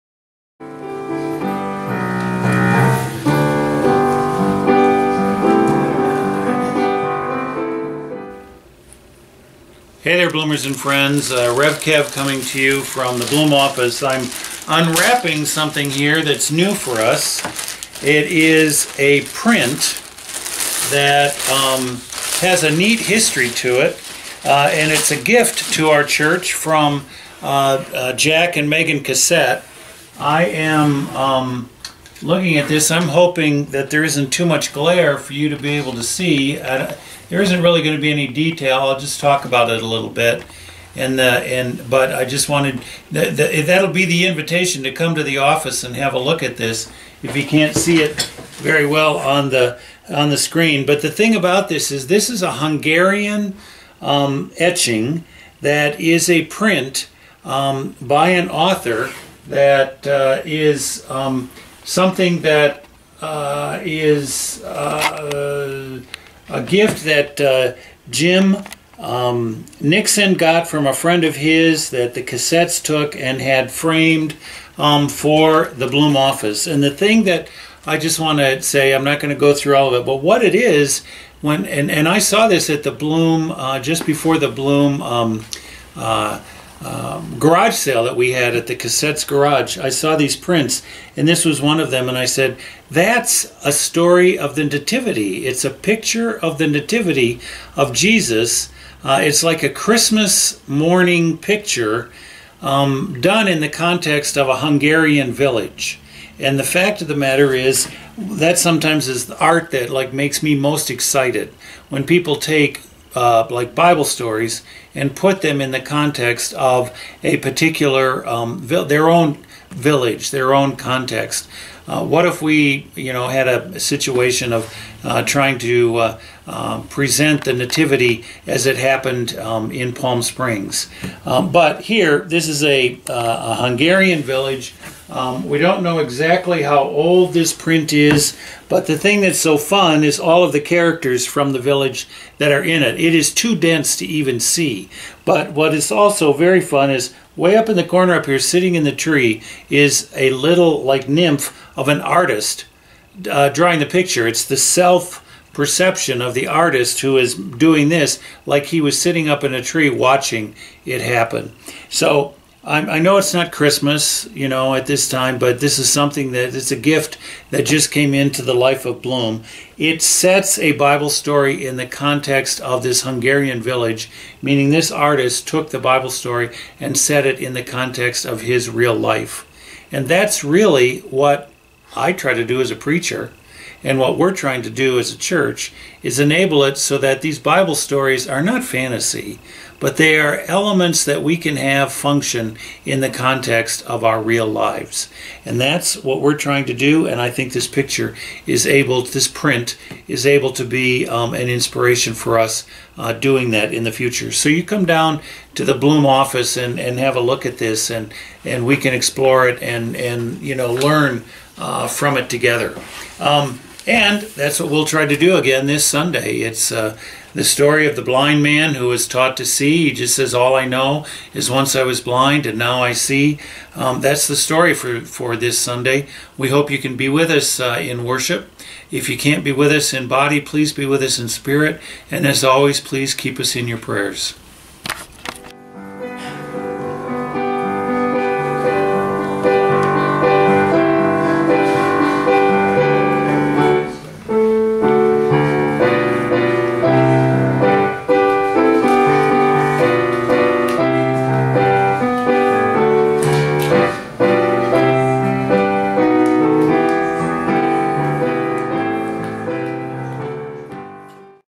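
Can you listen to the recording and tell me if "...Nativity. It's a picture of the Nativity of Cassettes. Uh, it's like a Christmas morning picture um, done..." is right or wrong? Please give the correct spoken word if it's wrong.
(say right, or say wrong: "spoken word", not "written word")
wrong: "Jesus", not "Cassettes".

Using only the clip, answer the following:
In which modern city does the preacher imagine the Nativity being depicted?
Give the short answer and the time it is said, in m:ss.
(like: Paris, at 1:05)
Palm Springs, at 2:09.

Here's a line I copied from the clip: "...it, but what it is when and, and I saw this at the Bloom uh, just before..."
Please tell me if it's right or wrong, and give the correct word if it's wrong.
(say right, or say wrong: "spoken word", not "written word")
right.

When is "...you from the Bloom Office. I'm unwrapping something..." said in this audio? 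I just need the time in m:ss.
0:12.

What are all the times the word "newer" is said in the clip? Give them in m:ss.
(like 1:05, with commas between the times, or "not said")
not said.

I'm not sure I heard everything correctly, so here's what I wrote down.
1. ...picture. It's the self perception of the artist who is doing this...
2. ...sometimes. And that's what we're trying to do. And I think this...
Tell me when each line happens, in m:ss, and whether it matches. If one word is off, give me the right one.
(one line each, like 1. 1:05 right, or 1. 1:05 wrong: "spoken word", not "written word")
1. 2:33 right
2. 3:14 wrong: "lives", not "sometimes".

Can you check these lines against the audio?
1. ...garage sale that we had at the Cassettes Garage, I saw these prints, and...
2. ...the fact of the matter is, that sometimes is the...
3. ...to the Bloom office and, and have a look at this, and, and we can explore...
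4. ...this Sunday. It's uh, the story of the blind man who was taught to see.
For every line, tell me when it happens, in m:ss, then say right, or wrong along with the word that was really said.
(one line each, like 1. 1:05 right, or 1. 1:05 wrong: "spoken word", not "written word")
1. 1:27 right
2. 1:46 right
3. 3:25 right
4. 3:35 right.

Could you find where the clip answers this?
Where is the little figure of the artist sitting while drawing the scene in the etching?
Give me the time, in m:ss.
2:28.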